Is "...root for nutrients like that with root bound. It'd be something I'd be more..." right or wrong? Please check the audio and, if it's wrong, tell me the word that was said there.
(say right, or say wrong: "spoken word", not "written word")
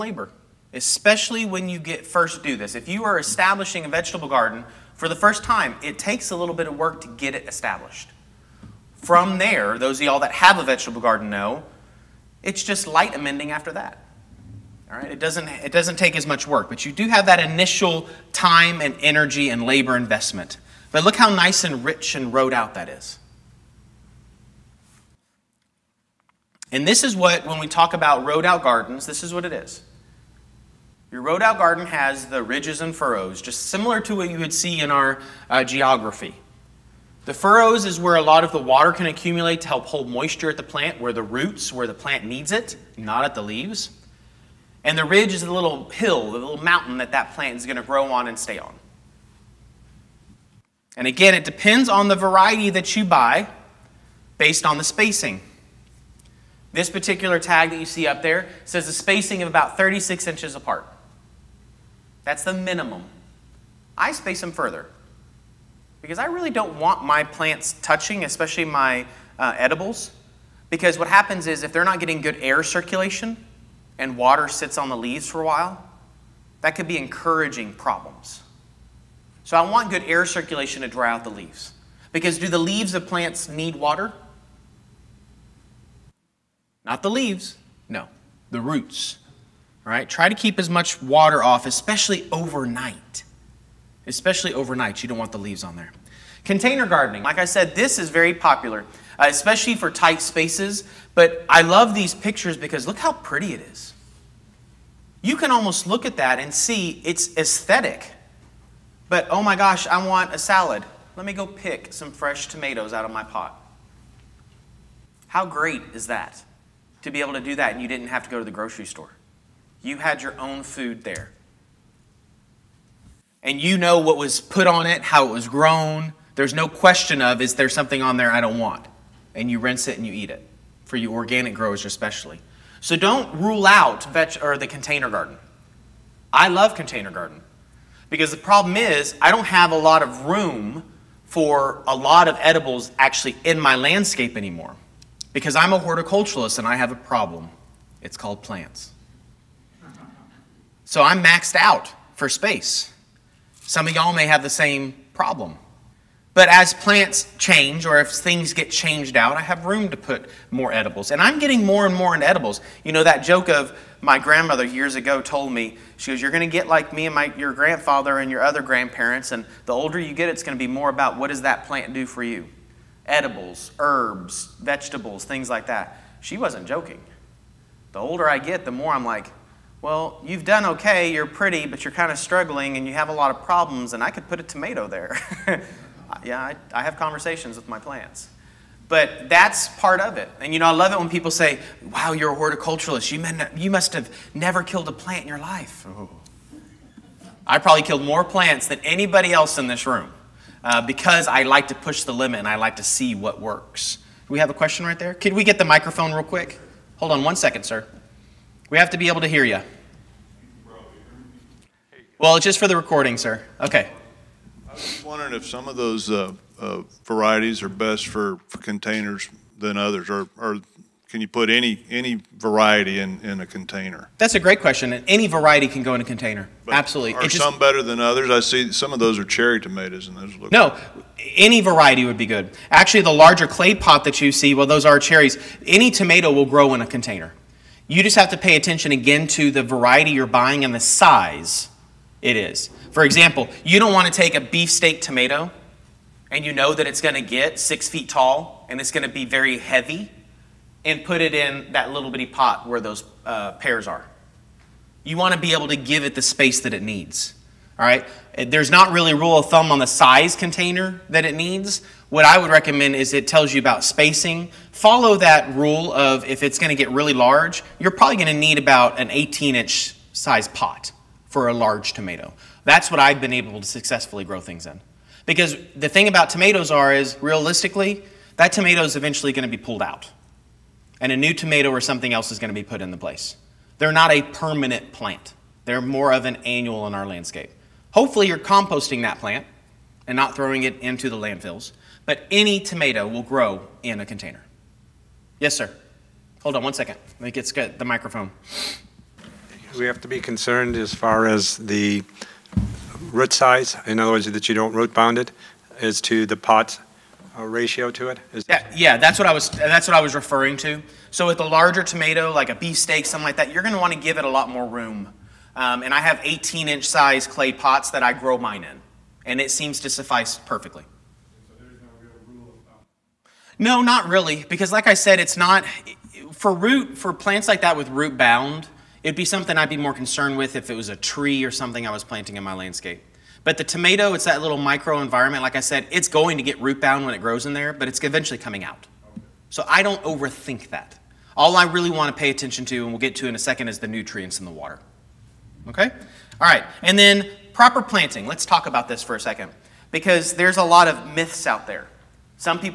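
wrong: "plants", not "nutrients".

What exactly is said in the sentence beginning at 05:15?
Um, and I have 18 inch size clay pots that I grow mine in, and it seems to suffice perfectly.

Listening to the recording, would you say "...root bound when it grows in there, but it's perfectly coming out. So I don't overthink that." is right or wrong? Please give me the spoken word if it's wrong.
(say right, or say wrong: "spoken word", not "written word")
wrong: "eventually", not "perfectly".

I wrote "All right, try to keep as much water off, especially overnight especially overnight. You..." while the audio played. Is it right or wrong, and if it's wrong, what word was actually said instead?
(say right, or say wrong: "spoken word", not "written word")
right.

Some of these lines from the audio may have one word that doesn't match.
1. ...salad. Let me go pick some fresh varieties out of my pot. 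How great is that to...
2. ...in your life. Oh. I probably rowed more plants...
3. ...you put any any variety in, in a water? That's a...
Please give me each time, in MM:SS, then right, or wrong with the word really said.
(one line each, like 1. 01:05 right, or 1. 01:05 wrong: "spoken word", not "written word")
1. 01:50 wrong: "tomatoes", not "varieties"
2. 03:15 wrong: "killed", not "rowed"
3. 03:41 wrong: "container", not "water".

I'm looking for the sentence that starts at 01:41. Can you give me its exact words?
But I love these pictures because look how pretty it is.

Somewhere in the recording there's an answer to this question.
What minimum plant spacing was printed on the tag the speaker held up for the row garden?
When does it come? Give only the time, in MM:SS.
00:59.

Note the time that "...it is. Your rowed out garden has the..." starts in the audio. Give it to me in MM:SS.
00:29.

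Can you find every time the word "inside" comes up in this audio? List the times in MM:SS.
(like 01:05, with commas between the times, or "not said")
not said.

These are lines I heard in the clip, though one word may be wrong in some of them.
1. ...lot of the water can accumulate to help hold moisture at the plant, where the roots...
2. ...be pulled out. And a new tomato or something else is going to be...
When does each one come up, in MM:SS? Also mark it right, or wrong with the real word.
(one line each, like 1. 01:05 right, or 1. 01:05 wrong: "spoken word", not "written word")
1. 00:38 right
2. 04:39 right.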